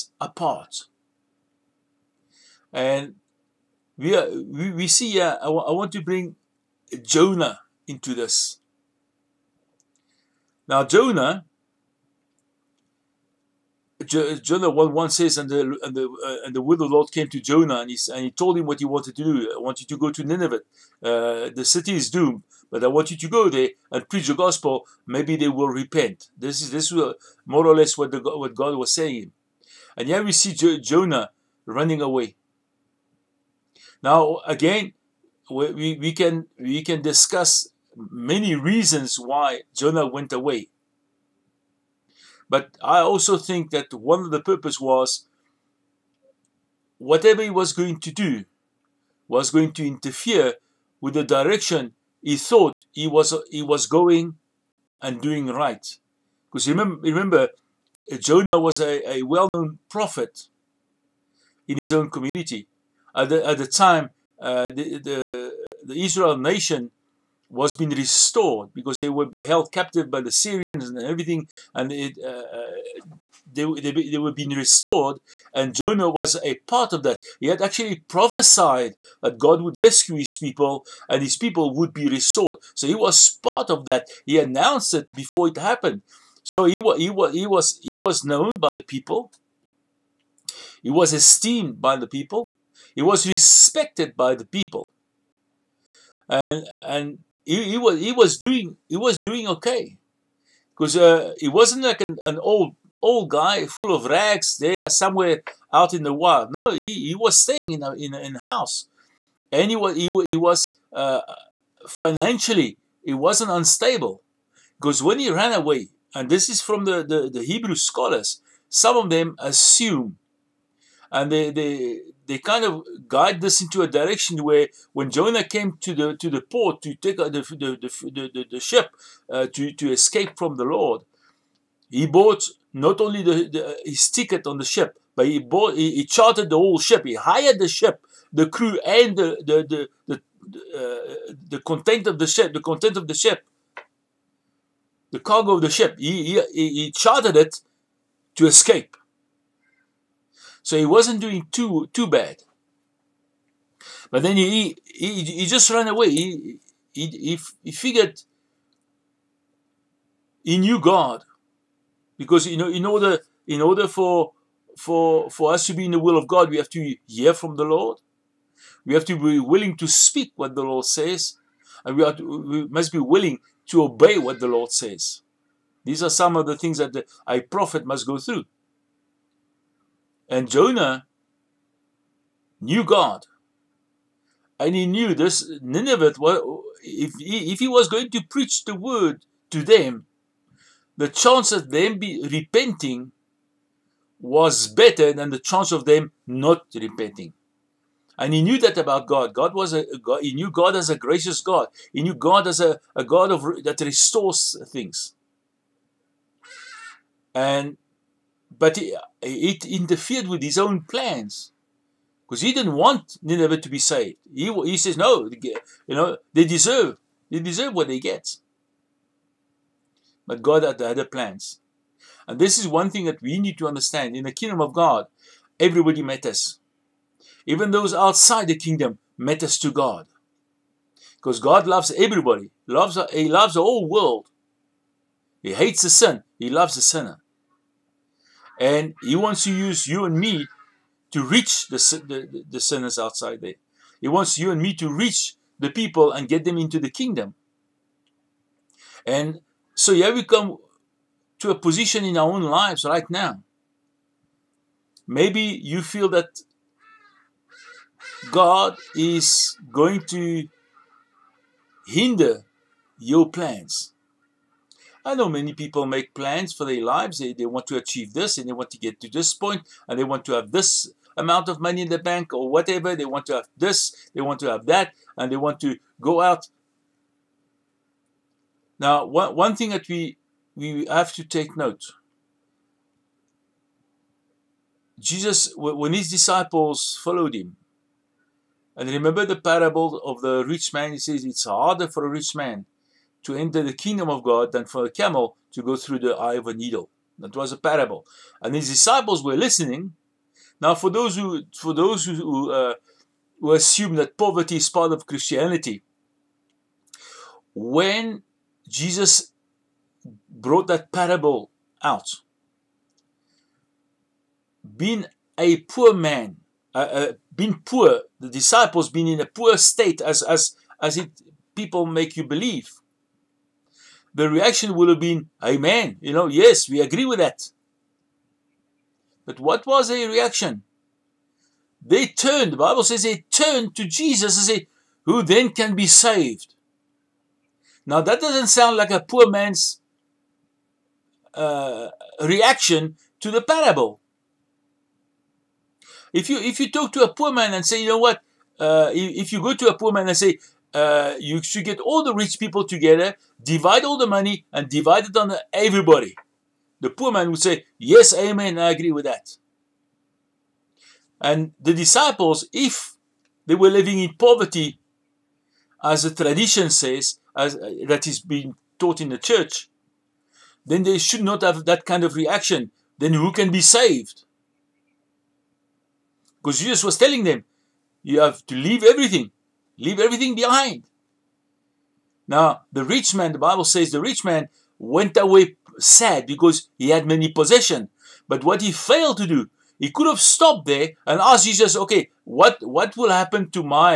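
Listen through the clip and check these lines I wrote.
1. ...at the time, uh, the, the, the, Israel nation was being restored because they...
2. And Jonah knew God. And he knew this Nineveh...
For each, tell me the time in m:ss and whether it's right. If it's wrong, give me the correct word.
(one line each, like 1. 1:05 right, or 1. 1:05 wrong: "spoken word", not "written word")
1. 1:03 right
2. 3:00 right.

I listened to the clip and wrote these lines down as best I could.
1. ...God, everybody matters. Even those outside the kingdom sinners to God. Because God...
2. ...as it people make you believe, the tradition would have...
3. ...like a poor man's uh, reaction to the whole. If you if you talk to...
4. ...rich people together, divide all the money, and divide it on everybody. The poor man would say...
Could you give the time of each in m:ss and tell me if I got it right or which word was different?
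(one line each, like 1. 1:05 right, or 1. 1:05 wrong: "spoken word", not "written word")
1. 3:44 wrong: "matters", not "sinners"
2. 5:20 wrong: "reaction", not "tradition"
3. 5:38 wrong: "parable", not "whole"
4. 5:52 right.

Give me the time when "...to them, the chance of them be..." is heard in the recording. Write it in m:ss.
3:09.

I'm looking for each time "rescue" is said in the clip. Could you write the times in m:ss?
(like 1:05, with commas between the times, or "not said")
1:19.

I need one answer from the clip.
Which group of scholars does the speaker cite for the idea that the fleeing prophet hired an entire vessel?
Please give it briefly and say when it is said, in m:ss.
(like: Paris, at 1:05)
Hebrew scholars, at 1:57.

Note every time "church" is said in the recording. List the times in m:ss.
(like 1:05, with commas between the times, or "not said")
6:09.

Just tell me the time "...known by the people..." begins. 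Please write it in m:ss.
1:28.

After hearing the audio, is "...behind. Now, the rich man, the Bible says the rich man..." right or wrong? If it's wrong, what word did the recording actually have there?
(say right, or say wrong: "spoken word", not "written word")
right.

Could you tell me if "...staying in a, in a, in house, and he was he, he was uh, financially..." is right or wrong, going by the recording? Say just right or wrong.
right.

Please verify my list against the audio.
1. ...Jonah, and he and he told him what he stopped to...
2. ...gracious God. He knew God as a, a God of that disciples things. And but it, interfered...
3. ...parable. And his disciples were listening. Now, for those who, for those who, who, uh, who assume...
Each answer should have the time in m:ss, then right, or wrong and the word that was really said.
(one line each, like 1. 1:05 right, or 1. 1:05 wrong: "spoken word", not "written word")
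1. 0:17 wrong: "wanted", not "stopped"
2. 3:20 wrong: "restores", not "disciples"
3. 4:57 right.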